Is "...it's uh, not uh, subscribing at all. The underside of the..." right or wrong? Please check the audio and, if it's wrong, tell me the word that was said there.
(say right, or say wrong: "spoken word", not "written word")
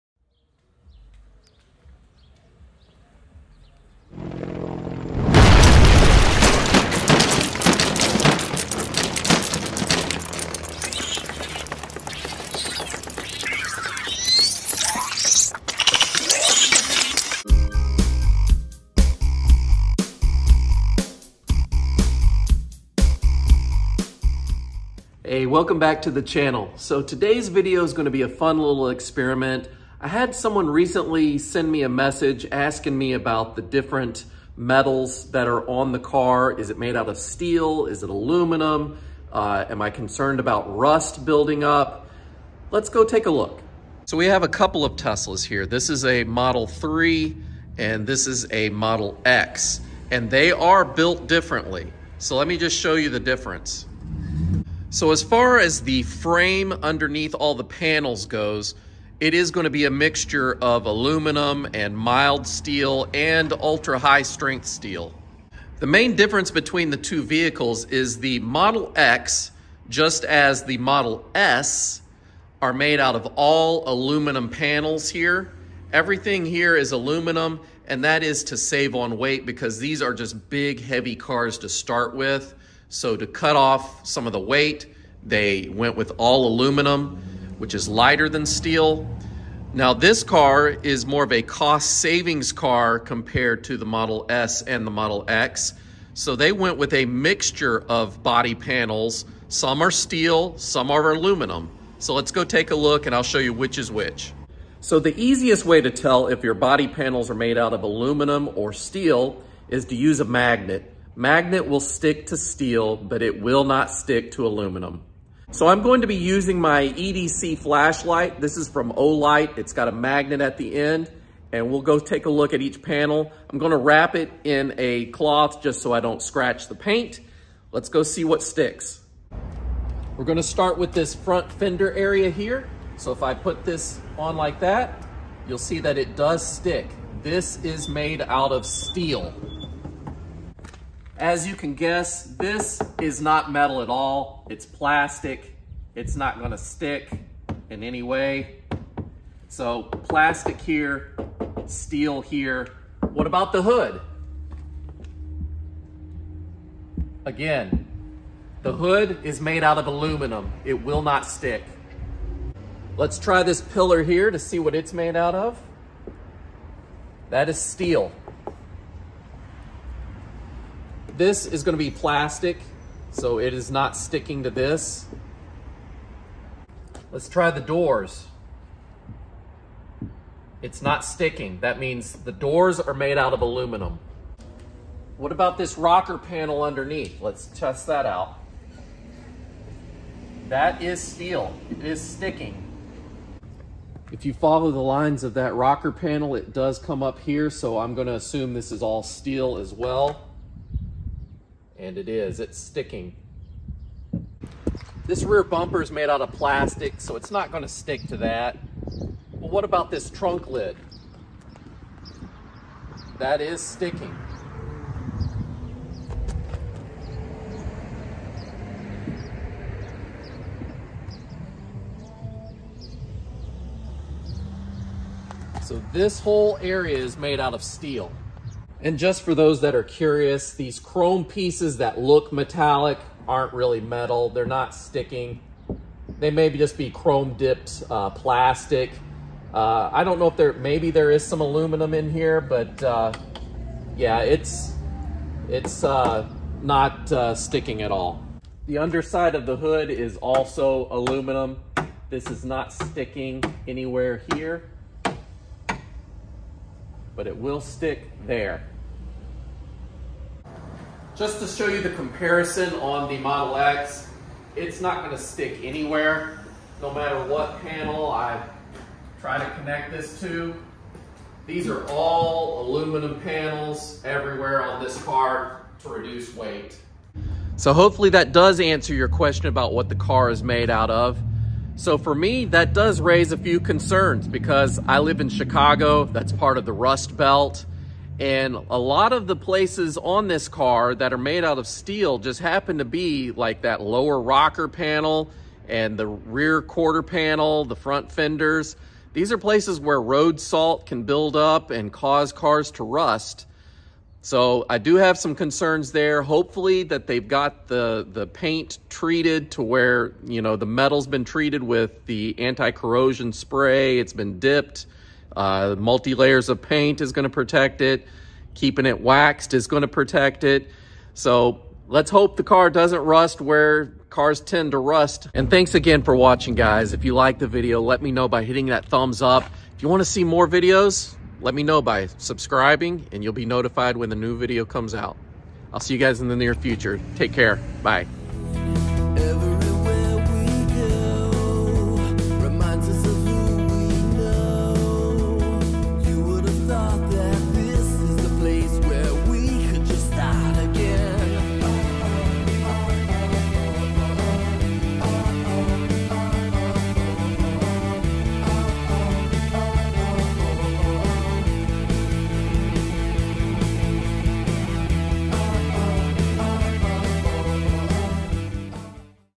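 wrong: "sticking", not "subscribing".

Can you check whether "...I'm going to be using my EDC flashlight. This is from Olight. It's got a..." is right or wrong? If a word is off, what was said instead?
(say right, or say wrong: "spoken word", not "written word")
right.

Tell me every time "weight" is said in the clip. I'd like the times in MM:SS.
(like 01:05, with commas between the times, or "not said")
01:19, 01:24, 04:36.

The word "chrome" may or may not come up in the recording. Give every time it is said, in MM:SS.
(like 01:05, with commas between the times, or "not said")
03:50, 03:56.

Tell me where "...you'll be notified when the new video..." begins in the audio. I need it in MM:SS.
05:33.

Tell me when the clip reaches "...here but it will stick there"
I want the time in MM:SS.
04:14.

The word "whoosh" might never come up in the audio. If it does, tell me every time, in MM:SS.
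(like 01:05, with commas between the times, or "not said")
not said.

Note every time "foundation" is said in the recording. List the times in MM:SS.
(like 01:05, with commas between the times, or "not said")
not said.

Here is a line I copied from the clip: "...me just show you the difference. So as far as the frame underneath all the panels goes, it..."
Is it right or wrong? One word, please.
right.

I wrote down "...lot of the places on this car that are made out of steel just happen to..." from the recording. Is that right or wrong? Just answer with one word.
right.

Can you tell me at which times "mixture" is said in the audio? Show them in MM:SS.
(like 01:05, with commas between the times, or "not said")
00:59, 01:37.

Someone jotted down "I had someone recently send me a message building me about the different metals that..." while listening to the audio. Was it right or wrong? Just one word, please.
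wrong.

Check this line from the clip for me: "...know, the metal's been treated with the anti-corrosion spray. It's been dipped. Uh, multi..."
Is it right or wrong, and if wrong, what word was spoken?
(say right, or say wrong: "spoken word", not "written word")
right.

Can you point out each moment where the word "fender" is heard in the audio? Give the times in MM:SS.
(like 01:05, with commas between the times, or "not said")
02:11, 04:58.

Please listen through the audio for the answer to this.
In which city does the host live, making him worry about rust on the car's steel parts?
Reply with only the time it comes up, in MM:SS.
04:45.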